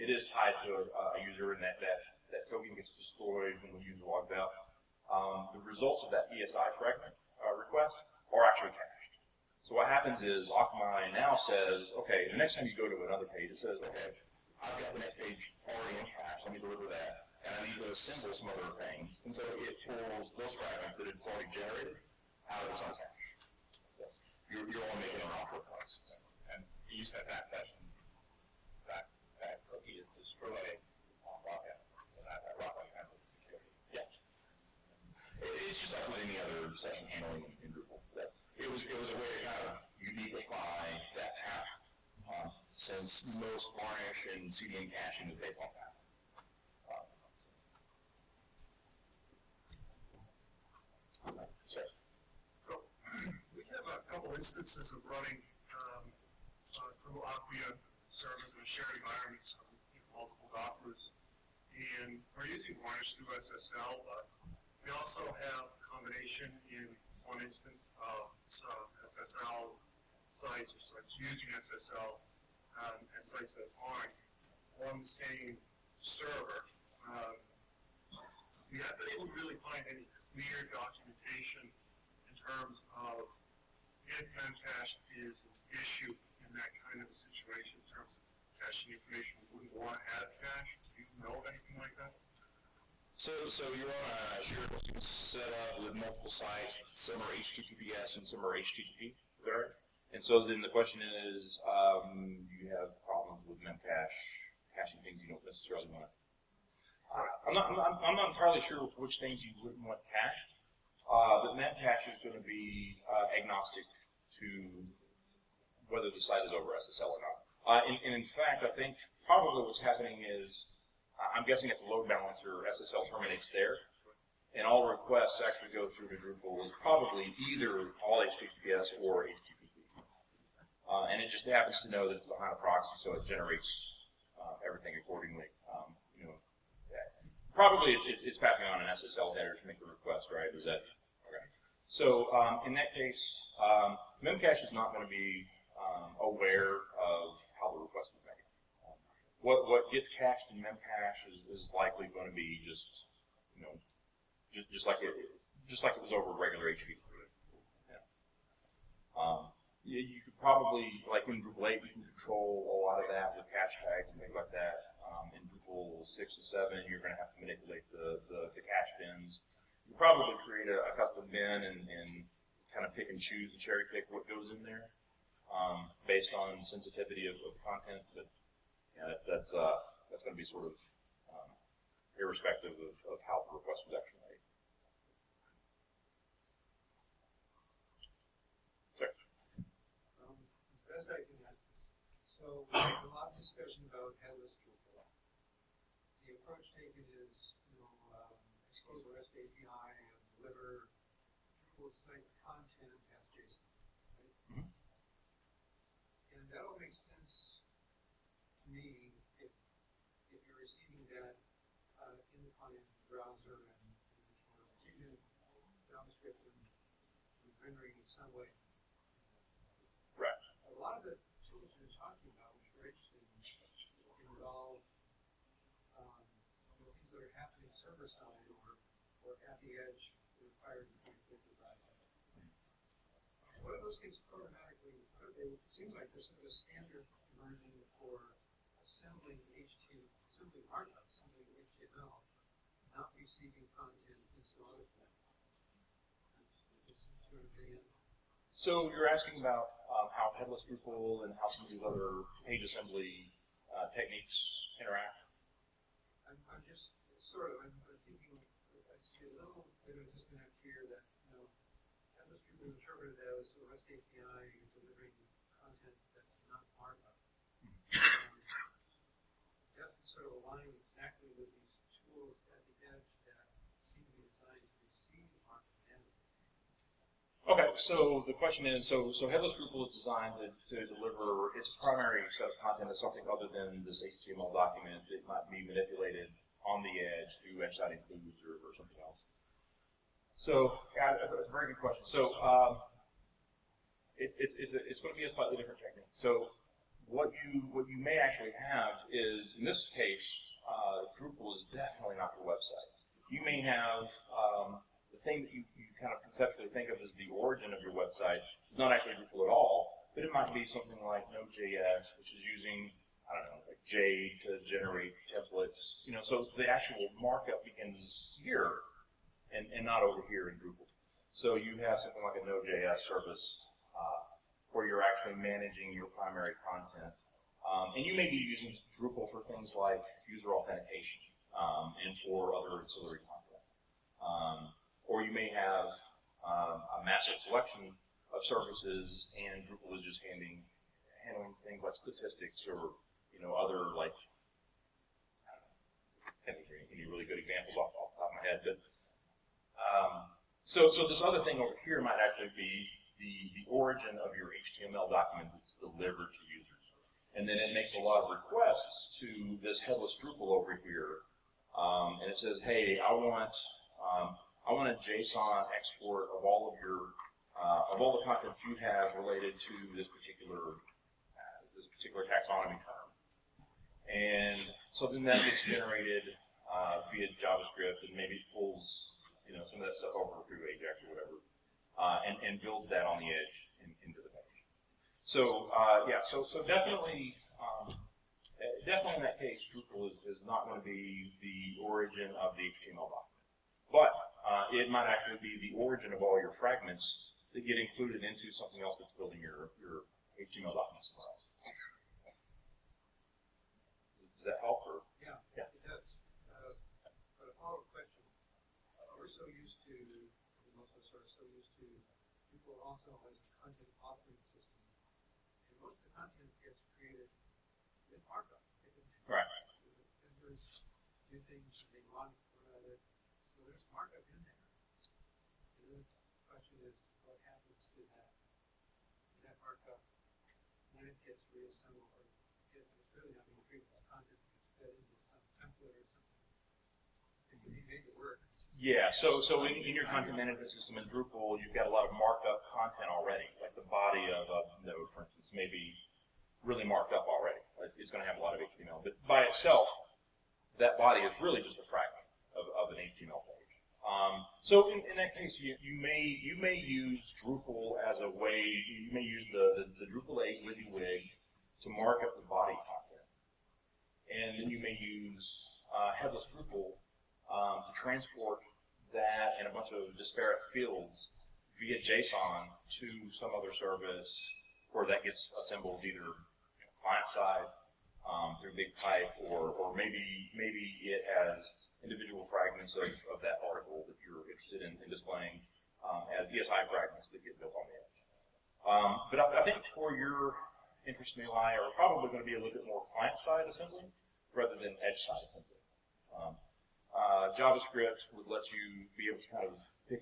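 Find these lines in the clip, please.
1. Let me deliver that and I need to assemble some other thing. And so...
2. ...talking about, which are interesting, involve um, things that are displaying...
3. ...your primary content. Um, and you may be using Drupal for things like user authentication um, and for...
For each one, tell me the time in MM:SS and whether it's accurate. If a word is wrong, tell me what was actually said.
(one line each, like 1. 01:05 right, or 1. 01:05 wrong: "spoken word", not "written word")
1. 00:16 right
2. 03:41 wrong: "happening", not "displaying"
3. 05:25 right.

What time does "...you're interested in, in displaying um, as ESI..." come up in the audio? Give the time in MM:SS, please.
08:04.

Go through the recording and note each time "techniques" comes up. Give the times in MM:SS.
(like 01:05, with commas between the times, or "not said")
04:13, 04:55.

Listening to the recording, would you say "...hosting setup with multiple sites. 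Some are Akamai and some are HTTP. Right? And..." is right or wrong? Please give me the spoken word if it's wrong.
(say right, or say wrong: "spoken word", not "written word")
wrong: "HTTPS", not "Akamai".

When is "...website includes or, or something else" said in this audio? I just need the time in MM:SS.
04:47.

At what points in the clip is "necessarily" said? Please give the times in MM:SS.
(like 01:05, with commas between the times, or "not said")
01:45.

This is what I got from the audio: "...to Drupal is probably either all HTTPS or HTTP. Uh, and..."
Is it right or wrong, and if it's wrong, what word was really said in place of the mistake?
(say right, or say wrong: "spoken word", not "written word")
right.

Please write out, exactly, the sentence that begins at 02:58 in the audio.
But yeah, that's that's uh, that's going to be sort of um, irrespective of, of how the request was actually made.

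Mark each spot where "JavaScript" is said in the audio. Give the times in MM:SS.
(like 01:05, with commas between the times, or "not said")
03:35, 06:17, 08:17.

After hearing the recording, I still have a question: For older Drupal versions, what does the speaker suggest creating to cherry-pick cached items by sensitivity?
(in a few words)
A custom bin.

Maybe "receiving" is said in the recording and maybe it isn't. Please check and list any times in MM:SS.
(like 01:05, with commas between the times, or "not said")
03:30, 04:03.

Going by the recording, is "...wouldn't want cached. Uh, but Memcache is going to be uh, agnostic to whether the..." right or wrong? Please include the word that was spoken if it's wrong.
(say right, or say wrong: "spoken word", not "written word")
right.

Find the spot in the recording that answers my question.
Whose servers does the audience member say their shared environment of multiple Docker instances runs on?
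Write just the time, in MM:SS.
00:57.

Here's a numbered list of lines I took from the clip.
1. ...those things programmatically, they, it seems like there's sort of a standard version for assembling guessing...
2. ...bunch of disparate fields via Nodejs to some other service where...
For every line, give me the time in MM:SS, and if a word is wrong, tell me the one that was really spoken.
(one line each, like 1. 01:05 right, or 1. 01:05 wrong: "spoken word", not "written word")
1. 03:53 wrong: "assembling", not "guessing"
2. 07:49 wrong: "JSON", not "Nodejs".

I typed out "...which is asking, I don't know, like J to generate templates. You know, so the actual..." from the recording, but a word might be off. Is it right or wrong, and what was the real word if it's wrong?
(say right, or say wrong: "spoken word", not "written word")
wrong: "using", not "asking".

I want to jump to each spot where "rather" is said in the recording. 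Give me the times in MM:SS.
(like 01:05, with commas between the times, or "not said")
08:14.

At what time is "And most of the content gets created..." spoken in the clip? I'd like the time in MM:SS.
06:55.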